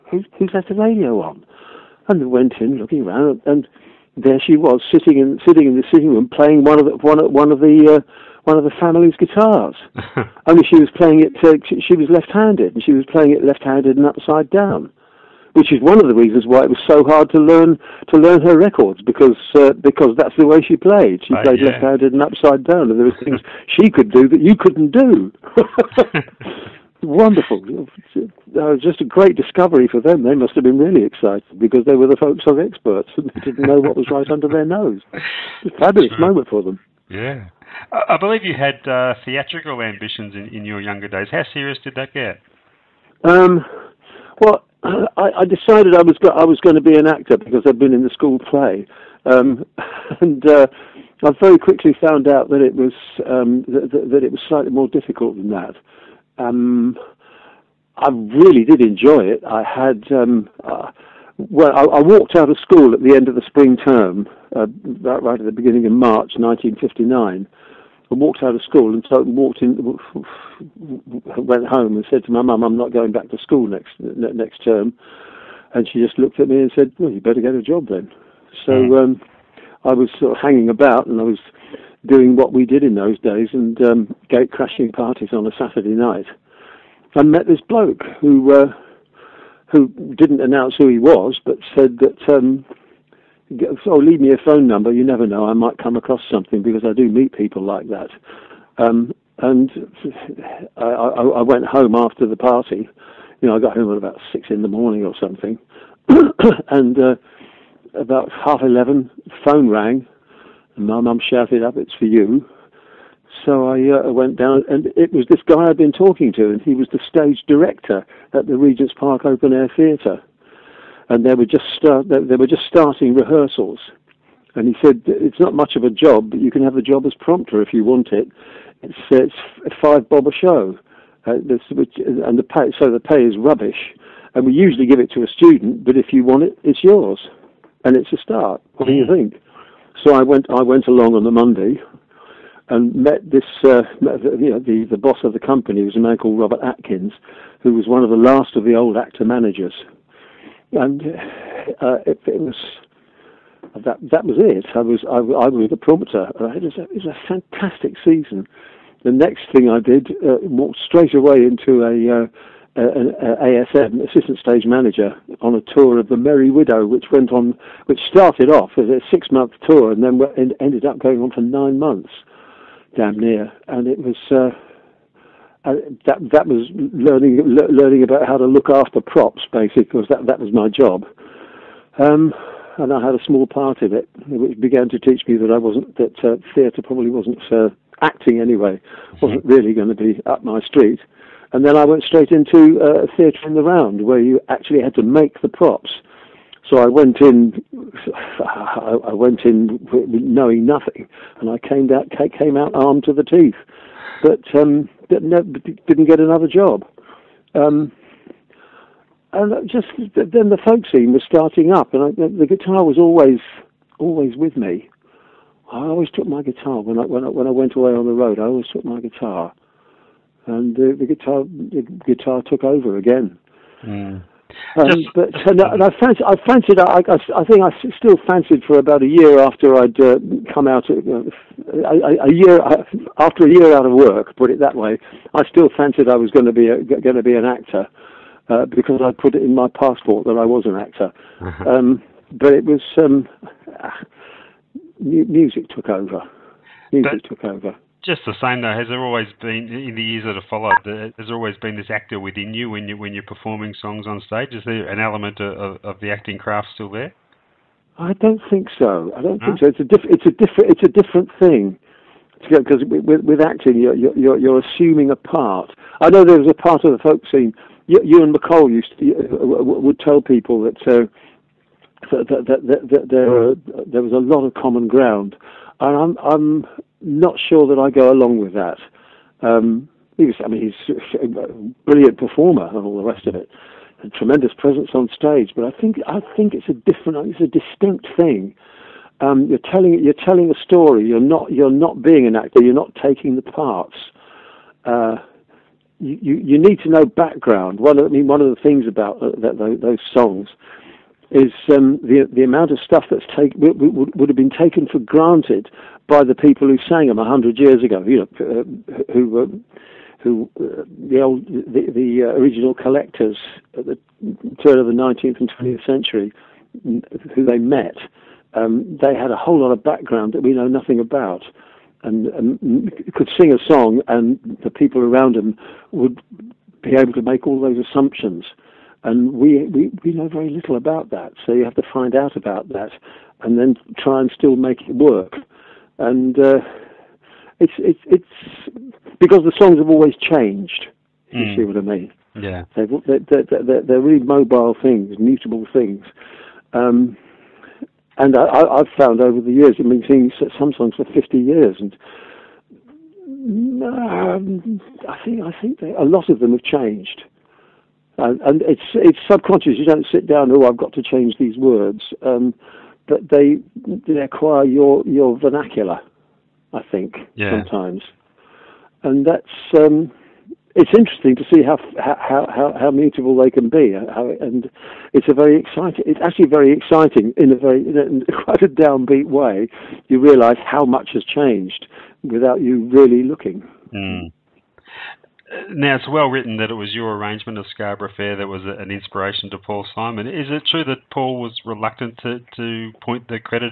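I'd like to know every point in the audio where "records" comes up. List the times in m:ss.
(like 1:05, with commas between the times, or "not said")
0:18.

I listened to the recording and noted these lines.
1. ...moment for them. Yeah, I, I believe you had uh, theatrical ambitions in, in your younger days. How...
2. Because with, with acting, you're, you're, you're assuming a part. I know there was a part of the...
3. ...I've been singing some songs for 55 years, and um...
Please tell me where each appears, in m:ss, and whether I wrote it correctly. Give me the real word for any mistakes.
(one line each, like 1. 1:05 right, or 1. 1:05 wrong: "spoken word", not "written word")
1. 0:36 right
2. 4:22 right
3. 5:49 wrong: "50", not "55".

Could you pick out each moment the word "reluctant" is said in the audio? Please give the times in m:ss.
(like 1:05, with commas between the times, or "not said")
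6:31.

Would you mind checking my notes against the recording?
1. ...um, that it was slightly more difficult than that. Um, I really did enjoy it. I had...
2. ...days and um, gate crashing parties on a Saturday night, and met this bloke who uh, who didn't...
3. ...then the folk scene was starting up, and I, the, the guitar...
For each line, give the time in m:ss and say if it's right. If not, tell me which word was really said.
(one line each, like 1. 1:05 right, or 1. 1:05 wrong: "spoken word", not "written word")
1. 0:53 right
2. 1:23 right
3. 3:30 right.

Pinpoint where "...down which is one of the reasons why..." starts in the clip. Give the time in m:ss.
0:14.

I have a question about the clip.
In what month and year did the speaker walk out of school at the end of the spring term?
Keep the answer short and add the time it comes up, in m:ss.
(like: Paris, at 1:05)
March 1959, at 1:05.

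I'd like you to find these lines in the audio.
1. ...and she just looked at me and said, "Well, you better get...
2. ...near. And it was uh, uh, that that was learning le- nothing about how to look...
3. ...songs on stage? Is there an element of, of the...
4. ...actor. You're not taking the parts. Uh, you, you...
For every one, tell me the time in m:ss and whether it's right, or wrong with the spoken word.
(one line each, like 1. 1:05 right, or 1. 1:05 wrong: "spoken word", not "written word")
1. 1:15 right
2. 2:53 wrong: "learning", not "nothing"
3. 4:13 right
4. 4:52 right.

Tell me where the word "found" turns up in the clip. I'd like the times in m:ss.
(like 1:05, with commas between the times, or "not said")
0:52, 5:48.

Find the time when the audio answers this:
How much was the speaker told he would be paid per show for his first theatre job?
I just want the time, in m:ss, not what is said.
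2:09.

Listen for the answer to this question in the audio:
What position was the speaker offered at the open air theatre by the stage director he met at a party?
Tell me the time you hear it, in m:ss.
2:07.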